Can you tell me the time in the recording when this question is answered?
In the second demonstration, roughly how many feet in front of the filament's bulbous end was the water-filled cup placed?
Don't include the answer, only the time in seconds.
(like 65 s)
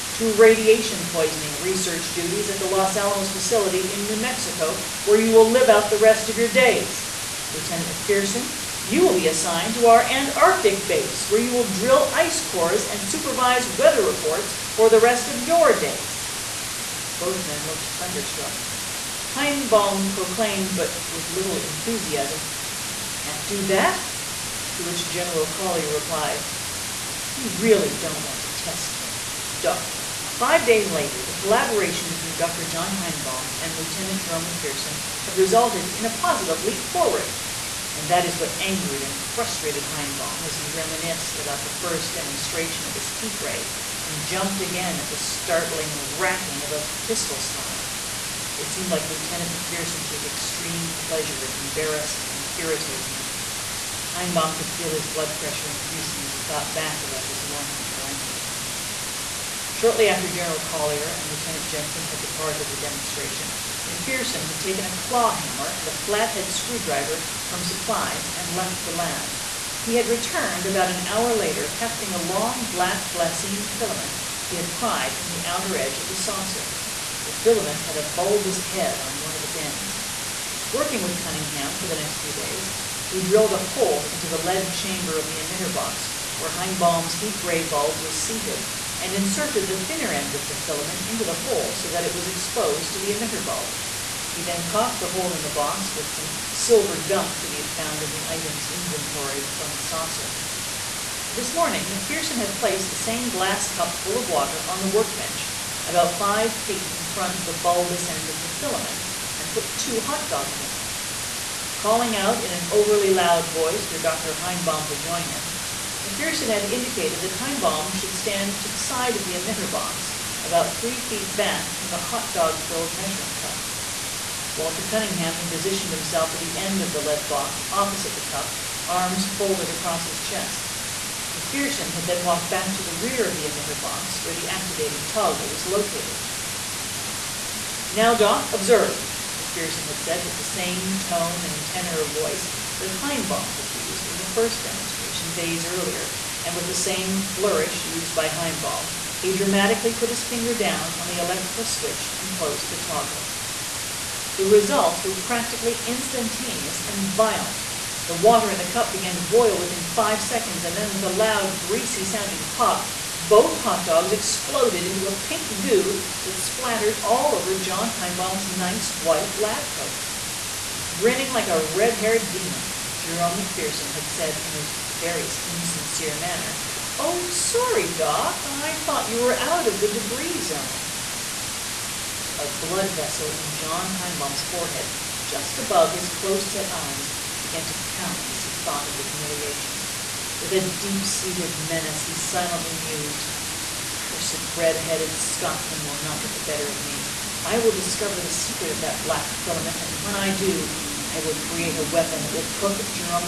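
106 s.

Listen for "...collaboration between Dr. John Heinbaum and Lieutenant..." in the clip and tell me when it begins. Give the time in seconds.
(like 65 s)
31 s.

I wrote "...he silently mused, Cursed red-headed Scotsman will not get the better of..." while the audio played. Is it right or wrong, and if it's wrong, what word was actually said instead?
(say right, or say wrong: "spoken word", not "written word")
right.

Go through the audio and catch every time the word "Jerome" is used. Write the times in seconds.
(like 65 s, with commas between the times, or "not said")
34 s, 172 s.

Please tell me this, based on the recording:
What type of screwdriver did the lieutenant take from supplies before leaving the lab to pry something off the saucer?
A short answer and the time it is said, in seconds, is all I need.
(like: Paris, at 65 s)
flathead, at 65 s.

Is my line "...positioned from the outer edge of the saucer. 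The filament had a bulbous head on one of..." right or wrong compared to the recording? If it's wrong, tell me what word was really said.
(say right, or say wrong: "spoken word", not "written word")
wrong: "pried", not "positioned".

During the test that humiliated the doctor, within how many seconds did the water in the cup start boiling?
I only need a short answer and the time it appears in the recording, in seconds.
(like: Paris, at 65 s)
5, at 159 s.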